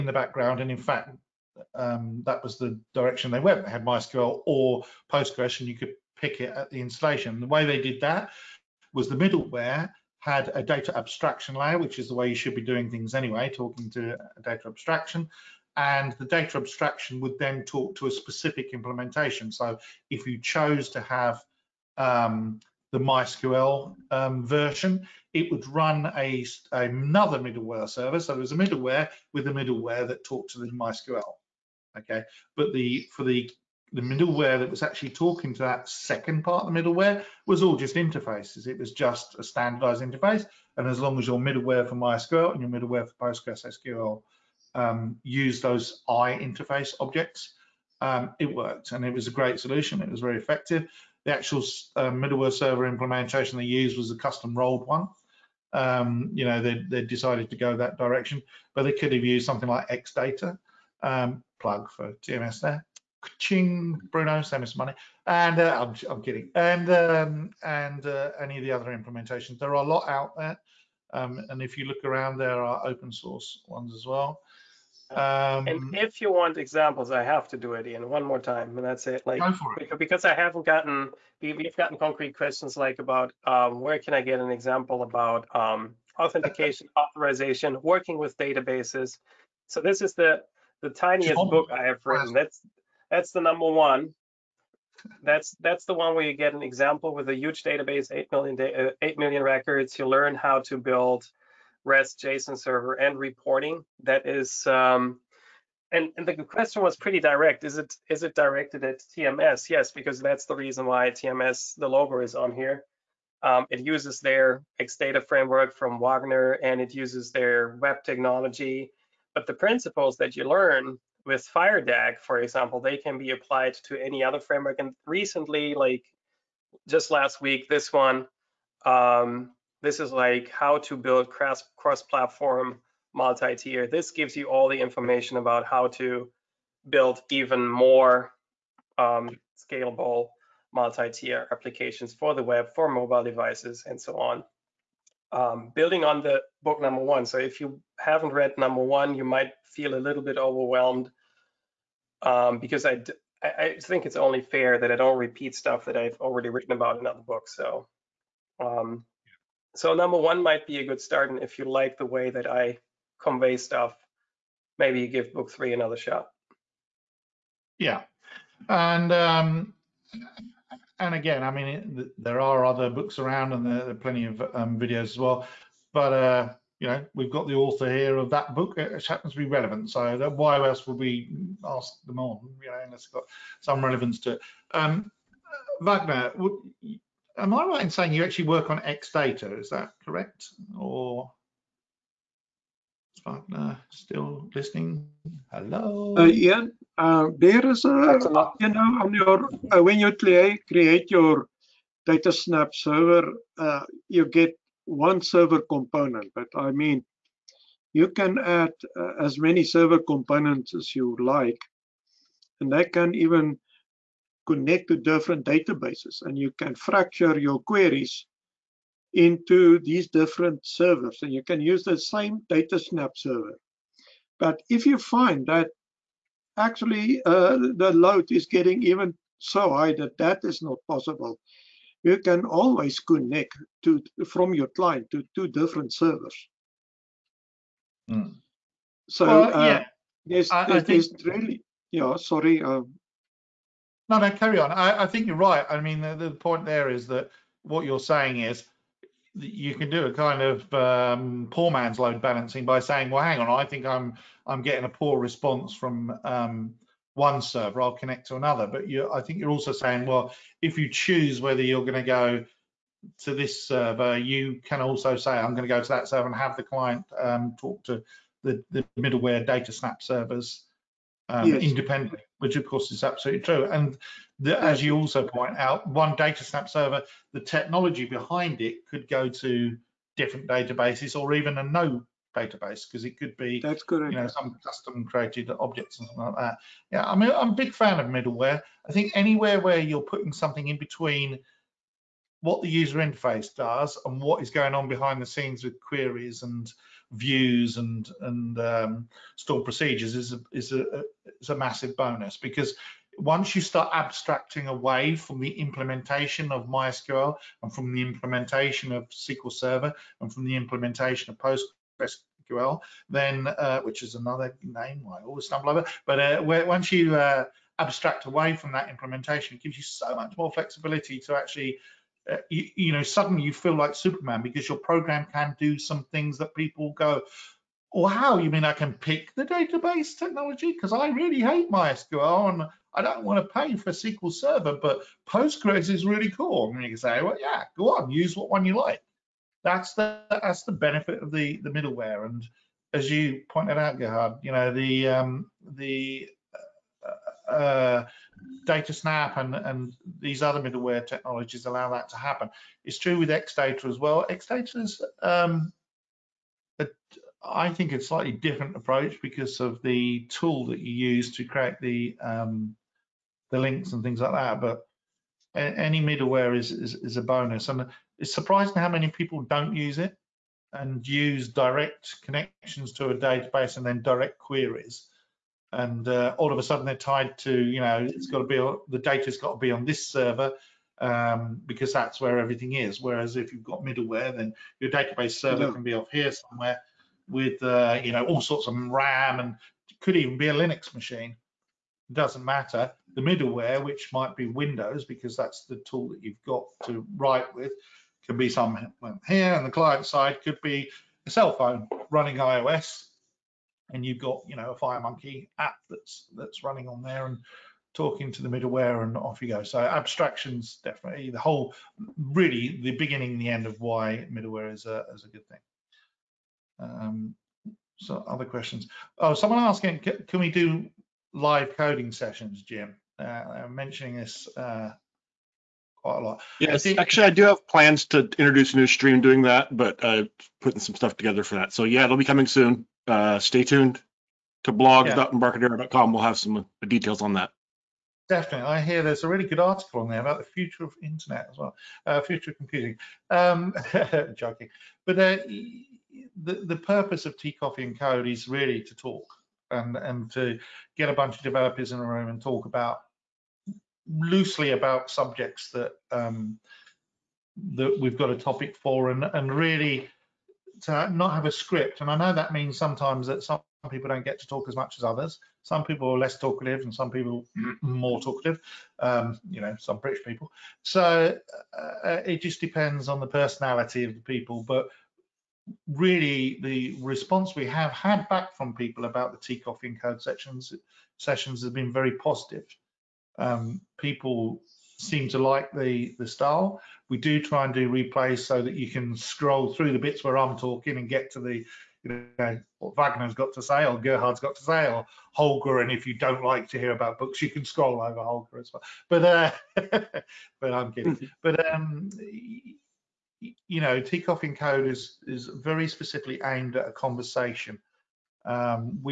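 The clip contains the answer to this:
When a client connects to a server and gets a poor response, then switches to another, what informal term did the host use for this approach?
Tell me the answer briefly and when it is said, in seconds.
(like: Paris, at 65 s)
poor man's load balancing, at 251 s.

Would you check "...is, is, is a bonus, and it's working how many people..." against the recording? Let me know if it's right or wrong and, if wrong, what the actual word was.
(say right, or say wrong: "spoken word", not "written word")
wrong: "surprising", not "working".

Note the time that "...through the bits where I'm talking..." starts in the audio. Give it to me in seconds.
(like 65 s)
489 s.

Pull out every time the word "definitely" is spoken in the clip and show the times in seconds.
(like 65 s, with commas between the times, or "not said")
410 s, 438 s.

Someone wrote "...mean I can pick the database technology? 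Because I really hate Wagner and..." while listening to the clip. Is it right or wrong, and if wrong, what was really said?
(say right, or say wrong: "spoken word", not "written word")
wrong: "MySQL", not "Wagner".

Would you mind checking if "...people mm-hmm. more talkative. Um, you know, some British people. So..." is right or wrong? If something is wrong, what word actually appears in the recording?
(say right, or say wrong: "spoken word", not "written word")
right.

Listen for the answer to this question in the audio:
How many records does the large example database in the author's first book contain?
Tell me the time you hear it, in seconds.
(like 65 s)
99 s.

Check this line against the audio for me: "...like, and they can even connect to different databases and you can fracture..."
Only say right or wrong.
right.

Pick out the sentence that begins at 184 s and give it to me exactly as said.
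Um, Wagner, would, am I right in saying you actually work on XData?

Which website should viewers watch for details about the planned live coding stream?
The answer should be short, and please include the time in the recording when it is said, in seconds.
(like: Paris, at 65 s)
blog.embarcadero.com, at 434 s.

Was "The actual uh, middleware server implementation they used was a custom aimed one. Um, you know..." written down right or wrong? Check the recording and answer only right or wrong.
wrong.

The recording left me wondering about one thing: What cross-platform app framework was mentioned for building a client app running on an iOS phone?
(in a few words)
FireMonkey.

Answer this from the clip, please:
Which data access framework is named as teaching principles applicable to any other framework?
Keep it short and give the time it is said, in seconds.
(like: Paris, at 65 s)
FireDAC, at 121 s.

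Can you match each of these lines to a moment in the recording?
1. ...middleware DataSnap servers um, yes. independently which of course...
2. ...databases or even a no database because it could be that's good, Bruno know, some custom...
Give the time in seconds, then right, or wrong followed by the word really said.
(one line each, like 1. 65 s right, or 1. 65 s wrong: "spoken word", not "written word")
1. 268 s right
2. 280 s wrong: "You", not "Bruno".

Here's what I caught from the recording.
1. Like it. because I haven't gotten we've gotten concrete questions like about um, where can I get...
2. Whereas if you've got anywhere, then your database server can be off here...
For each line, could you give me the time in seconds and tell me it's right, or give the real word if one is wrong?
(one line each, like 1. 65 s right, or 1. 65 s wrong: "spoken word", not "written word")
1. 79 s right
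2. 383 s wrong: "middleware", not "anywhere".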